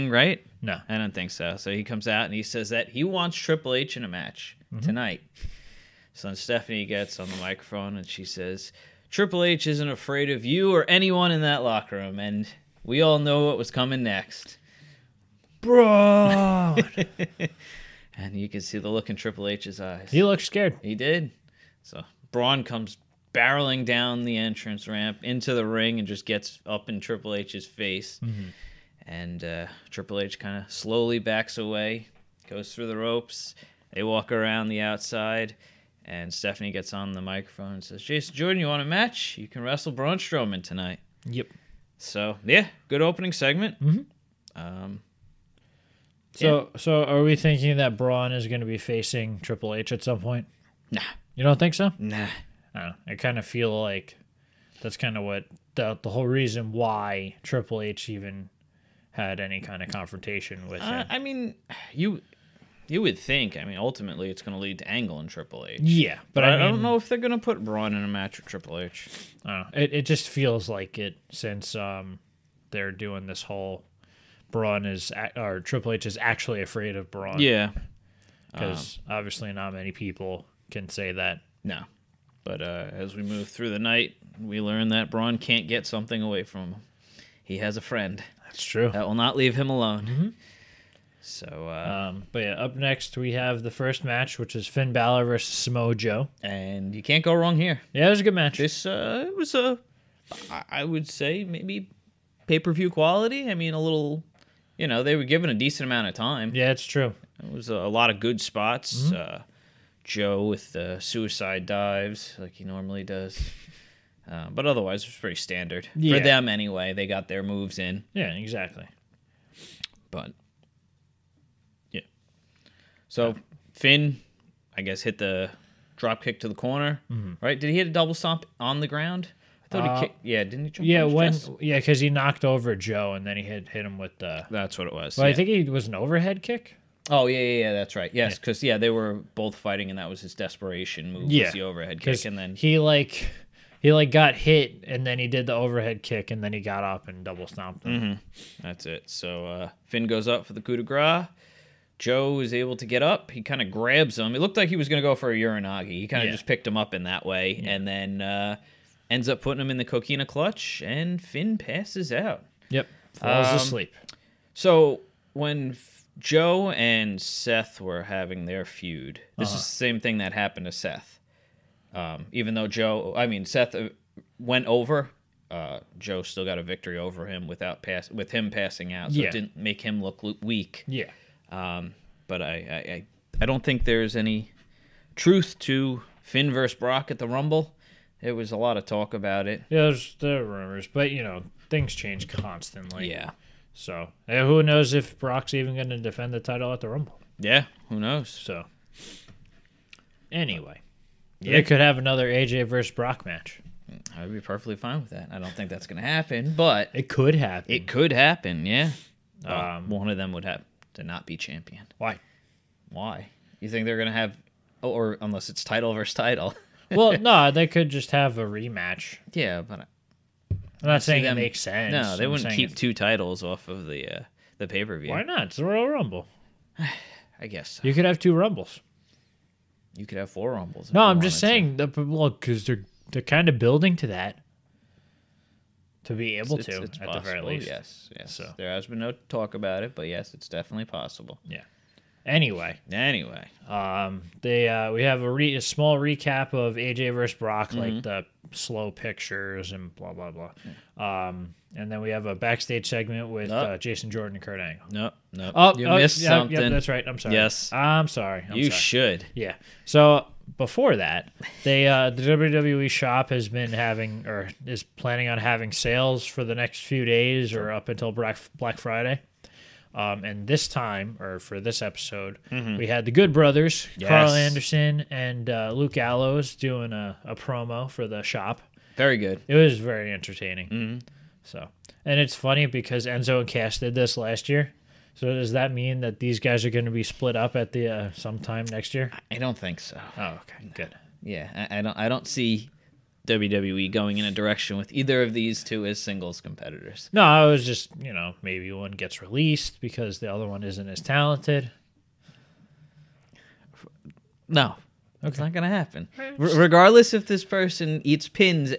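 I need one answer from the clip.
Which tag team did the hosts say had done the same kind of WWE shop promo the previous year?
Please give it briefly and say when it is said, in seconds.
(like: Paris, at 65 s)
Enzo and Cass, at 283 s.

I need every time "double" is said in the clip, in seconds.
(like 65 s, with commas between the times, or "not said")
127 s, 147 s.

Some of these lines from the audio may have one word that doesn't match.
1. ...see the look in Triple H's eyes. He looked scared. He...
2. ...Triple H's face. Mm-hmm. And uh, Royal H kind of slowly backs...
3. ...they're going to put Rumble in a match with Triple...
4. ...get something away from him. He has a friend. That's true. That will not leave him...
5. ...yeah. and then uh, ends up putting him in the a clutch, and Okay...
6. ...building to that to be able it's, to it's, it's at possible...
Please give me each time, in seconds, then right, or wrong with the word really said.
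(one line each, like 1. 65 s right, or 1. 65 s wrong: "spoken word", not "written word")
1. 18 s right
2. 27 s wrong: "Triple", not "Royal"
3. 67 s wrong: "Braun", not "Rumble"
4. 85 s right
5. 157 s wrong: "Finn", not "Okay"
6. 233 s right.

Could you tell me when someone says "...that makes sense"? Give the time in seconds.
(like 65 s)
221 s.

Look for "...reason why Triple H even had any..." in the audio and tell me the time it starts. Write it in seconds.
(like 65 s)
56 s.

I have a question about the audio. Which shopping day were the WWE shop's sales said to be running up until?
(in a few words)
Black Friday.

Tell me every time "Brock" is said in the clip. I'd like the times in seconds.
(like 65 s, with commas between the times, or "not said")
186 s, 195 s, 202 s, 247 s.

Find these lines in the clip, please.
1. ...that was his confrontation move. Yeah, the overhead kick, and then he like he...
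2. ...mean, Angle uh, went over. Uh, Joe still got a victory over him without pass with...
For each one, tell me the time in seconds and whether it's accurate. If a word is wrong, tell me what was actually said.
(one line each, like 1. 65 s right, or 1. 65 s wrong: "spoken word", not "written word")
1. 139 s wrong: "desperation", not "confrontation"
2. 173 s wrong: "Seth", not "Angle".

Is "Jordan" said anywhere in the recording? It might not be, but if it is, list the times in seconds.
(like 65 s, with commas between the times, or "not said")
38 s, 254 s.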